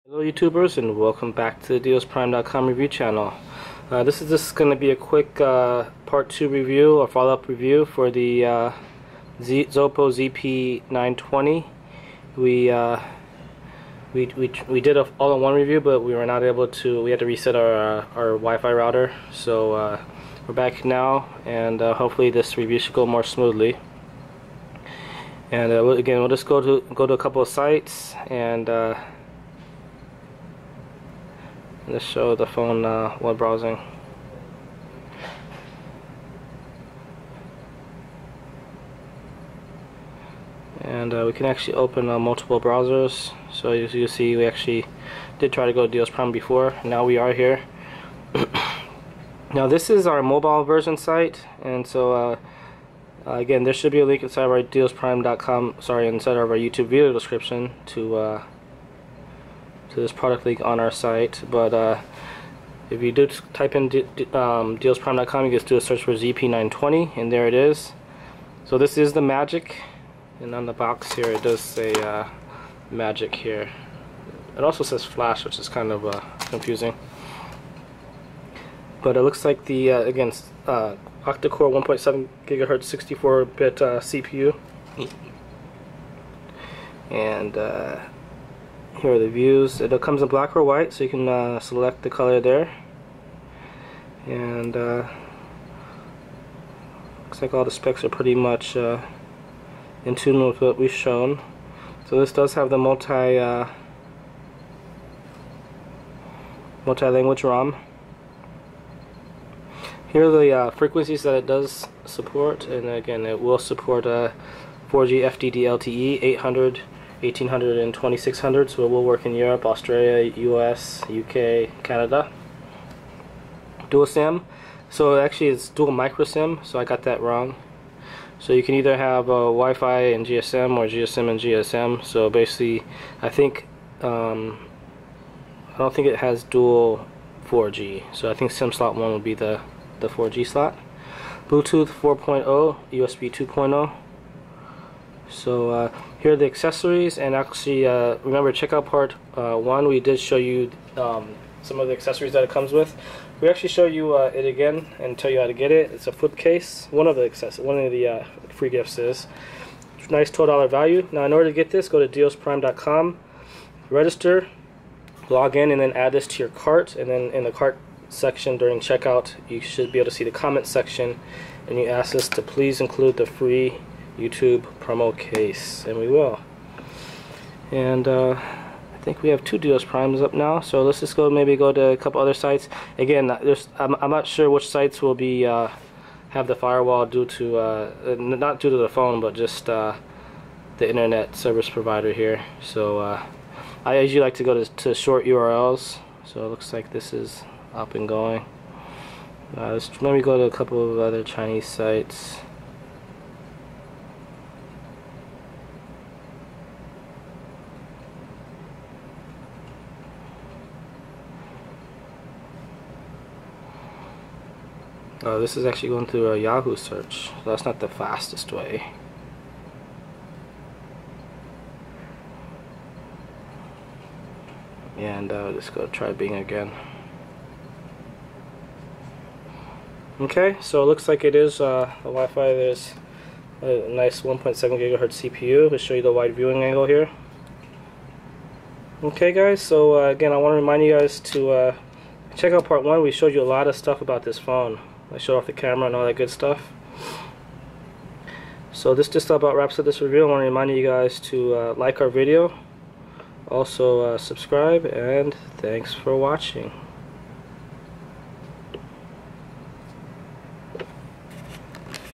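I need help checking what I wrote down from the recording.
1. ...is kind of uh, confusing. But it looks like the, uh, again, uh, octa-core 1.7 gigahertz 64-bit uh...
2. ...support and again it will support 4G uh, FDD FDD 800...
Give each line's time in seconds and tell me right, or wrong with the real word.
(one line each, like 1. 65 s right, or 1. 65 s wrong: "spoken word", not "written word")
1. 75 s right
2. 112 s wrong: "LTE", not "FDD".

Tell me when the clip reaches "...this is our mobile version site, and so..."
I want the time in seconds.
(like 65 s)
49 s.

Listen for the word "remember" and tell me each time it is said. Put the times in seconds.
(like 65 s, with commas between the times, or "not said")
148 s.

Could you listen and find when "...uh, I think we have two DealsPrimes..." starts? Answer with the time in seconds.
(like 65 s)
178 s.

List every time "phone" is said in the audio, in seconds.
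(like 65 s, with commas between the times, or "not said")
32 s, 188 s, 244 s.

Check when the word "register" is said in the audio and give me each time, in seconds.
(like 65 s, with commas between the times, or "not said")
163 s.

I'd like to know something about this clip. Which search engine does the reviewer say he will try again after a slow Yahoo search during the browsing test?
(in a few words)
Bing.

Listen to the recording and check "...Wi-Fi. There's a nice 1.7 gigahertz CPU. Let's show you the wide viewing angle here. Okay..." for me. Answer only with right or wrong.
right.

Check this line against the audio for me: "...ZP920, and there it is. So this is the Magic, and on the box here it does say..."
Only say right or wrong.
right.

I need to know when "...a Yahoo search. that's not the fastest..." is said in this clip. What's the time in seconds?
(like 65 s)
216 s.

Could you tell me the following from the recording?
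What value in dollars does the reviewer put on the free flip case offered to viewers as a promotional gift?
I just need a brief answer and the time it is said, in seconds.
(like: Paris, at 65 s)
$12, at 160 s.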